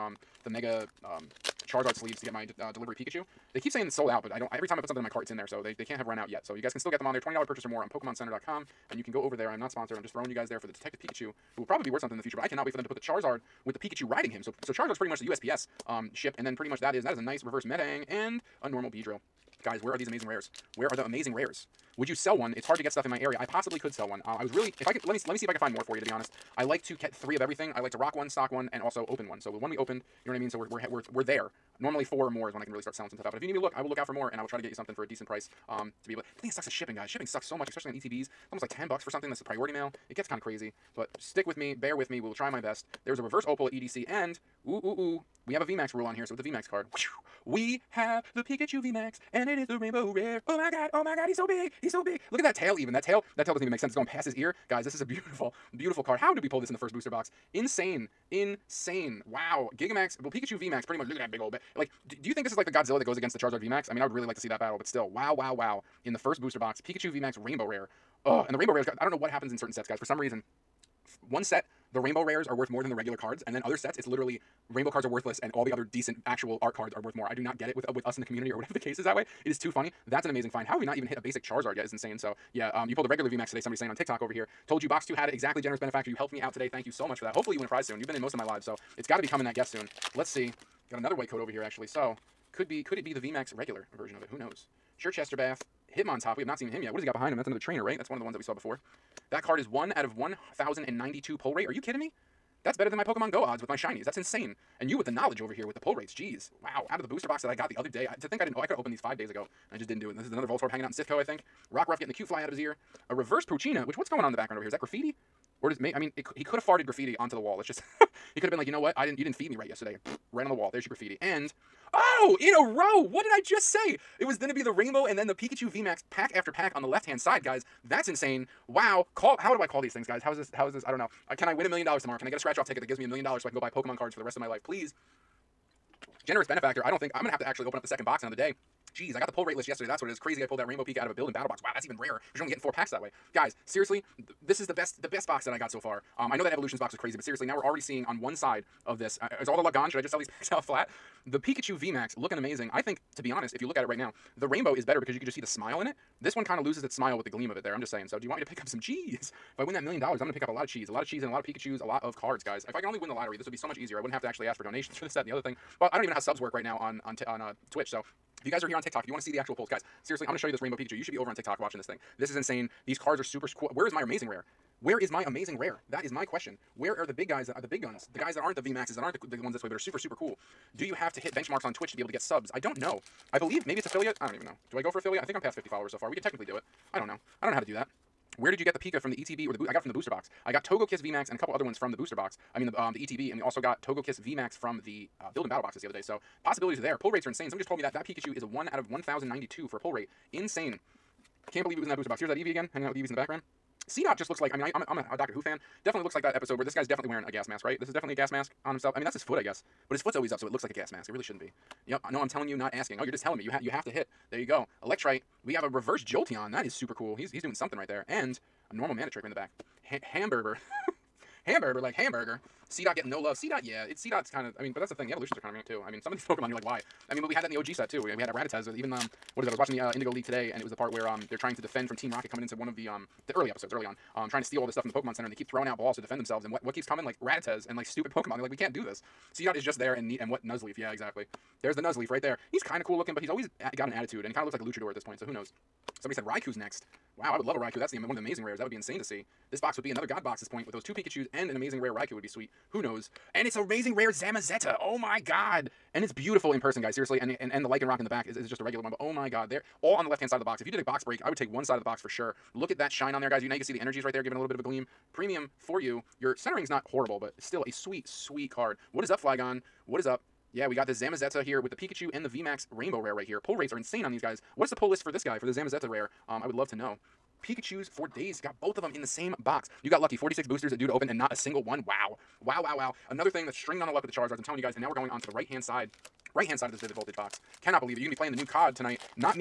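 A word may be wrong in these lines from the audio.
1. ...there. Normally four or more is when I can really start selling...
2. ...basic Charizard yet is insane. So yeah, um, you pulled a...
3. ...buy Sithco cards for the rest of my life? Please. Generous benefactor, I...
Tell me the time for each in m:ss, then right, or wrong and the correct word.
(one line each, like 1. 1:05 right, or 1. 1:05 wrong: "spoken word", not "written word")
1. 0:31 right
2. 1:21 right
3. 2:13 wrong: "Pokemon", not "Sithco".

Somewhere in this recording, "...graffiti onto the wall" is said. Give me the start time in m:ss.
1:56.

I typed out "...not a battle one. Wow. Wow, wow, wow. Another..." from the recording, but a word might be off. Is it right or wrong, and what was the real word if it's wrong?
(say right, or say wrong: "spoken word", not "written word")
wrong: "single", not "battle".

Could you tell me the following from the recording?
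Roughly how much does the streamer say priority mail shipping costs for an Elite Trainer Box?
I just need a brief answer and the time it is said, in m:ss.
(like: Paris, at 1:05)
10 bucks, at 0:38.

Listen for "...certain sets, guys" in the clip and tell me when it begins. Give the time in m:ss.
1:09.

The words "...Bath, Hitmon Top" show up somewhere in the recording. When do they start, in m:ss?
1:35.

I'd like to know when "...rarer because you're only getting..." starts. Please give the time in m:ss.
2:21.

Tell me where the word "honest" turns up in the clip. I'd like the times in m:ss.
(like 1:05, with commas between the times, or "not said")
0:26, 2:33.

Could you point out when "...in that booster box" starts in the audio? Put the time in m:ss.
3:21.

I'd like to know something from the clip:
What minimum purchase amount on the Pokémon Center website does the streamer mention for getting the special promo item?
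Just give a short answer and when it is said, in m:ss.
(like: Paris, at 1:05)
$20, at 0:07.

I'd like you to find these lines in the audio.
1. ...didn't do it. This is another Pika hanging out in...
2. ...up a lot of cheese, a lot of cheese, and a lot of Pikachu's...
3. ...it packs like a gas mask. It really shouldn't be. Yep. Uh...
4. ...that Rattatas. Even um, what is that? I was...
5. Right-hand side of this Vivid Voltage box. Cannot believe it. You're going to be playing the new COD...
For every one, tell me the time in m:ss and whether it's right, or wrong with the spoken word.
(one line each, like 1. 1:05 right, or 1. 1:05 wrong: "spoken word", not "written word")
1. 1:49 wrong: "Voltorb", not "Pika"
2. 2:40 right
3. 3:30 wrong: "looks", not "packs"
4. 3:48 right
5. 4:46 right.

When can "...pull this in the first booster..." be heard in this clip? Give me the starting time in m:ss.
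0:56.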